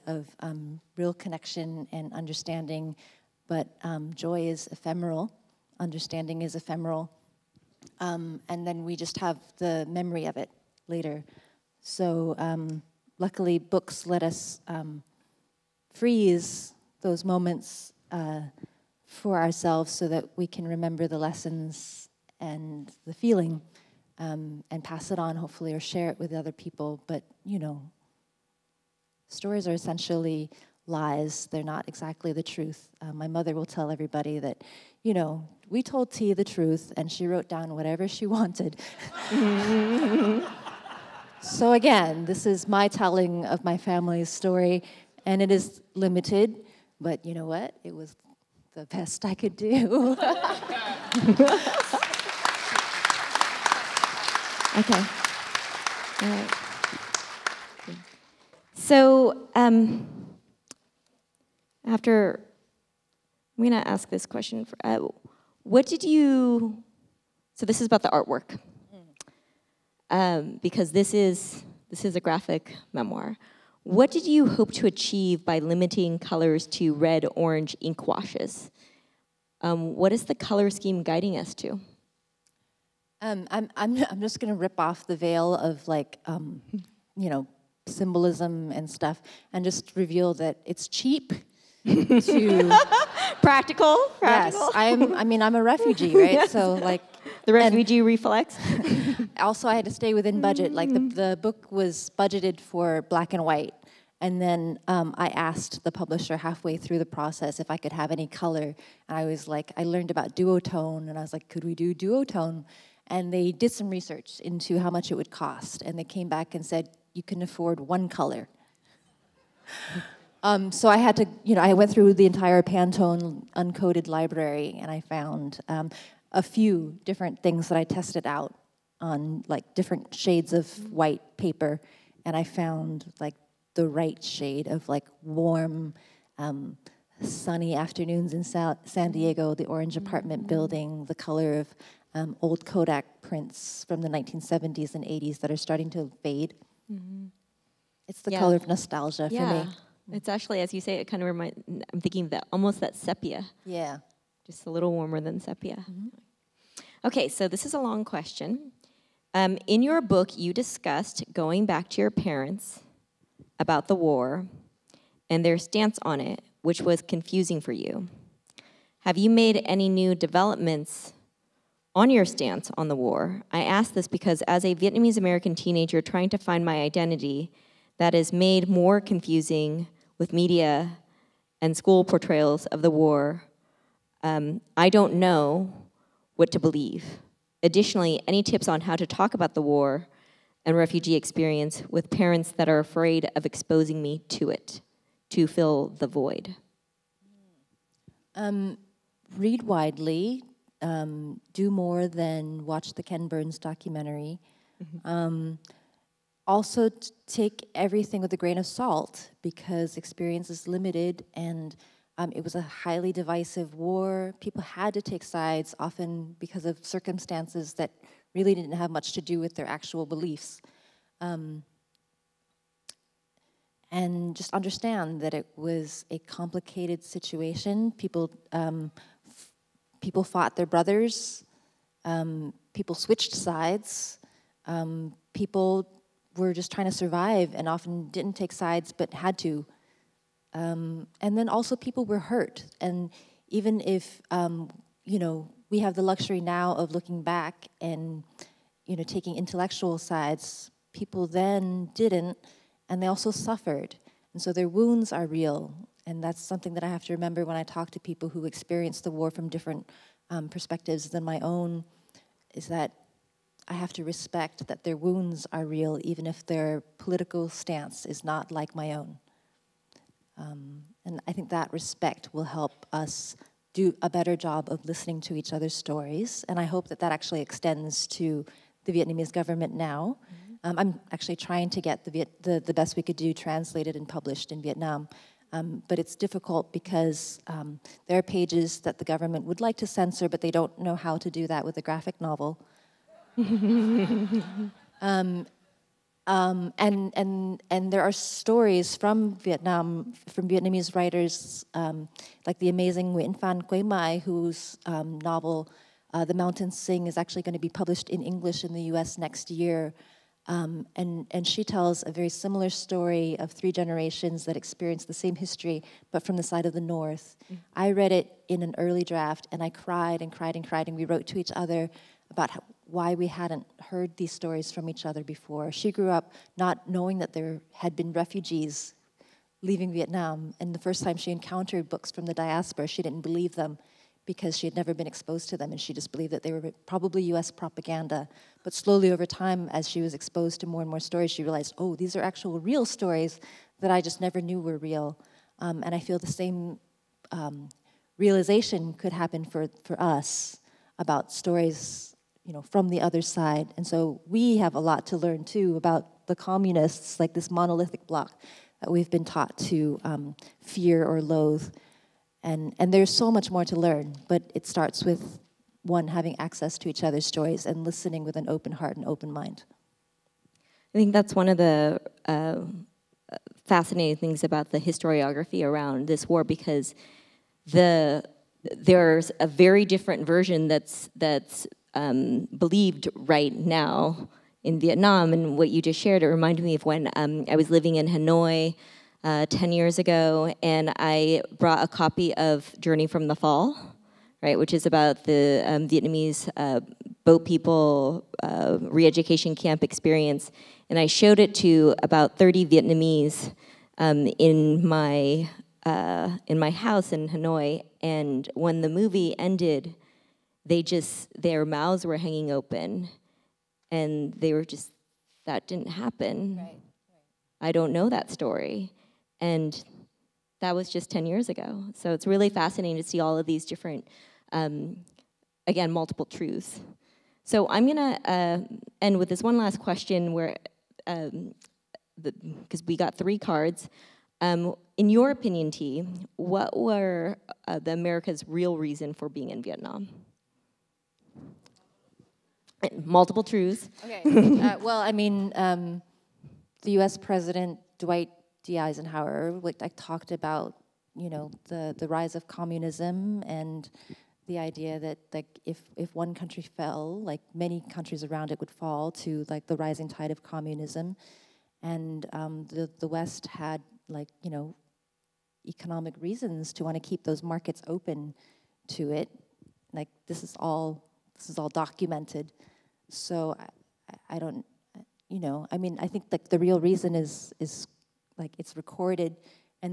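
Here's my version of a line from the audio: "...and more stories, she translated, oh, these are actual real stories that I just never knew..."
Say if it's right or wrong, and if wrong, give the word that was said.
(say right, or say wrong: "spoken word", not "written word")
wrong: "realized", not "translated".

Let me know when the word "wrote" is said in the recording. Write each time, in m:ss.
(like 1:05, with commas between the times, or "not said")
0:37, 5:21.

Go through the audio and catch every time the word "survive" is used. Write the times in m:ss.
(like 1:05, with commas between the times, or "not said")
3:56.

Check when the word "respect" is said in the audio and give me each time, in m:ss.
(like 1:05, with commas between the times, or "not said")
4:24, 4:31.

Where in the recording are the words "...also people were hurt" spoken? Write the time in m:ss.
4:01.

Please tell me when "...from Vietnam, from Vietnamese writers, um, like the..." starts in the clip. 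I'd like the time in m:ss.
4:58.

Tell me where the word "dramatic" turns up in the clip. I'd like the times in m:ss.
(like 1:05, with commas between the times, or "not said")
not said.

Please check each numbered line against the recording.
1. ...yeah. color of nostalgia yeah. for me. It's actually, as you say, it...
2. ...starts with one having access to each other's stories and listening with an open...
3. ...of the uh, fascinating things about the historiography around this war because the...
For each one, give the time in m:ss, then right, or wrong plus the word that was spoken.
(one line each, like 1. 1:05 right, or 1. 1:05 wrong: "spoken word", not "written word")
1. 2:28 right
2. 6:04 right
3. 6:11 right.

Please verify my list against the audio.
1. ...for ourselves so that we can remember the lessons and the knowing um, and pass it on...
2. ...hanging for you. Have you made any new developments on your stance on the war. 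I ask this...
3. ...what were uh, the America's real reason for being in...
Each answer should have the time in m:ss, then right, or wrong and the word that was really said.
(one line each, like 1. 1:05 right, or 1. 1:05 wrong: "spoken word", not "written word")
1. 0:19 wrong: "feeling", not "knowing"
2. 2:47 wrong: "confusing", not "hanging"
3. 7:16 right.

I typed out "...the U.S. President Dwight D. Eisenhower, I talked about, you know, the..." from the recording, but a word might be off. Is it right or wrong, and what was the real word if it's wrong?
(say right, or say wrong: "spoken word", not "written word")
right.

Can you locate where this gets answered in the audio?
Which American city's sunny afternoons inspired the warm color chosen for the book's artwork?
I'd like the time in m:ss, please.
2:18.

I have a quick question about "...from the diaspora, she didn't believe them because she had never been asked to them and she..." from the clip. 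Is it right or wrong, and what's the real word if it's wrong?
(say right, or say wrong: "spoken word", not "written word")
wrong: "exposed", not "asked".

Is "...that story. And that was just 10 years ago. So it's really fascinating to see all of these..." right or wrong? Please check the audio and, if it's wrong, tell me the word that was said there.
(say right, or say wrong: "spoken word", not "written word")
right.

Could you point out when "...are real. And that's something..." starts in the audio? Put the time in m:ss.
4:15.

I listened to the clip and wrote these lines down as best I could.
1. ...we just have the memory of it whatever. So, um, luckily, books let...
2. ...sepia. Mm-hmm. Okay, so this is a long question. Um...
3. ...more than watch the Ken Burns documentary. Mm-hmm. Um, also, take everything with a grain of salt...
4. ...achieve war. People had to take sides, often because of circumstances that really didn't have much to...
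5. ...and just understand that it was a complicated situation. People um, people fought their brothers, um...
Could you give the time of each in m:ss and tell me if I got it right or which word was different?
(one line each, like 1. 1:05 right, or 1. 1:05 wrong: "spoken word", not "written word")
1. 0:08 wrong: "later", not "whatever"
2. 2:35 right
3. 3:21 right
4. 3:33 wrong: "divisive", not "achieve"
5. 3:43 right.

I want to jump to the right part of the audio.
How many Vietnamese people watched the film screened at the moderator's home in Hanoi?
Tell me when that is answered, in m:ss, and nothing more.
6:42.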